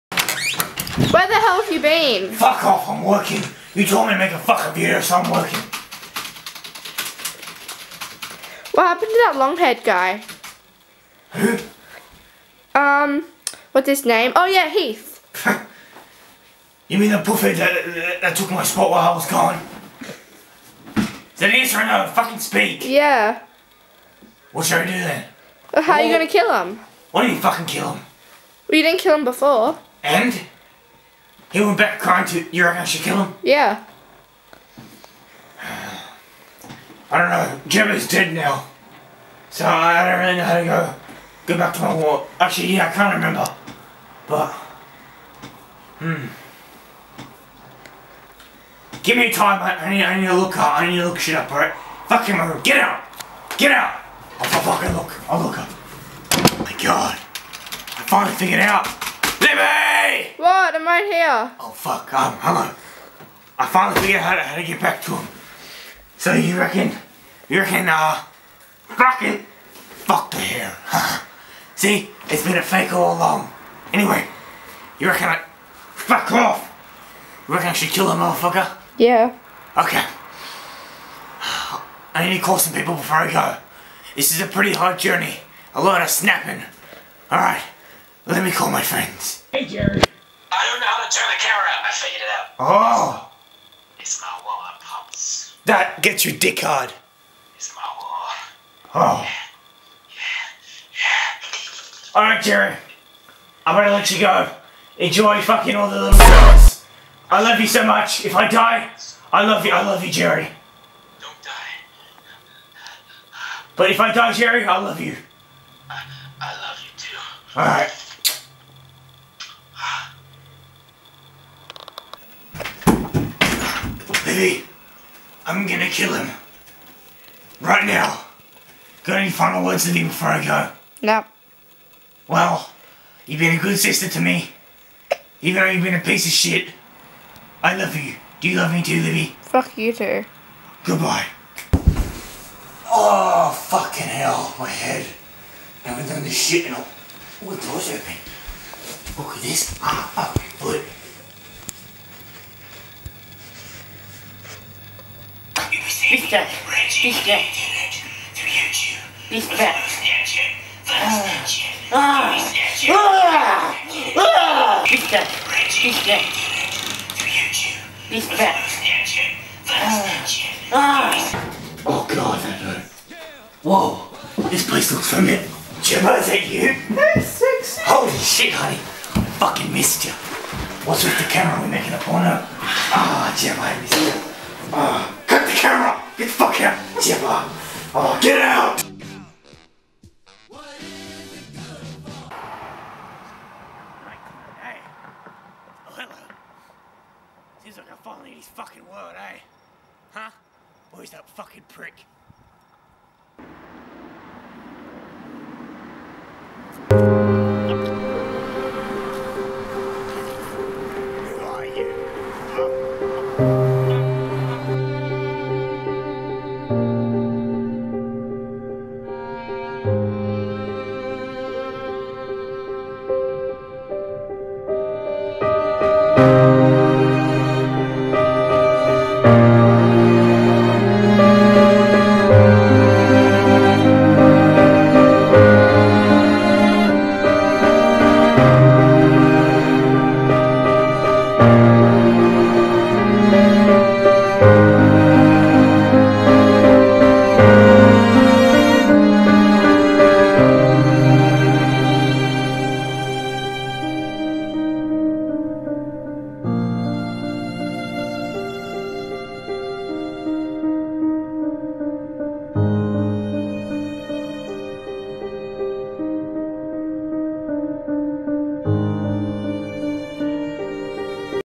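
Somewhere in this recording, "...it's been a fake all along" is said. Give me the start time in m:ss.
1:12.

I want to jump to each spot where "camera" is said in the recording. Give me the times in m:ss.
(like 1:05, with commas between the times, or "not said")
1:31, 3:01, 3:05.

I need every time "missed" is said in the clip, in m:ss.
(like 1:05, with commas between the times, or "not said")
2:59, 3:03.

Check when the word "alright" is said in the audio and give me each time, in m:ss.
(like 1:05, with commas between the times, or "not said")
0:51, 1:27, 1:42, 1:57.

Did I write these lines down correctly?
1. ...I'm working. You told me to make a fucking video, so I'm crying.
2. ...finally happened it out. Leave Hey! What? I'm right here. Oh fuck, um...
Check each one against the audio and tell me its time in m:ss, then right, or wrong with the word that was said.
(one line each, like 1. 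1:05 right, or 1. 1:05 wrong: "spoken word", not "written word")
1. 0:02 wrong: "working", not "crying"
2. 0:58 wrong: "figured", not "happened".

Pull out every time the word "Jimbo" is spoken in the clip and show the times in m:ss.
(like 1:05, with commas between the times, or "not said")
2:55, 3:03.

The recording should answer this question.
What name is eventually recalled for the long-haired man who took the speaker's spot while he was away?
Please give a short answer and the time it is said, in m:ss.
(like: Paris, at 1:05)
Heath, at 0:14.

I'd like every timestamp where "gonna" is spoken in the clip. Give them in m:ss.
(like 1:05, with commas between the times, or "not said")
0:26, 1:43, 2:05.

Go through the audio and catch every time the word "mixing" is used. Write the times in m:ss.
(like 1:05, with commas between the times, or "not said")
not said.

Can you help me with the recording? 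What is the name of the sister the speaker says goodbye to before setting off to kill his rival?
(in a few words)
Libby.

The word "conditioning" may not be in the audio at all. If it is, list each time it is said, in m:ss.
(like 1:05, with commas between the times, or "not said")
not said.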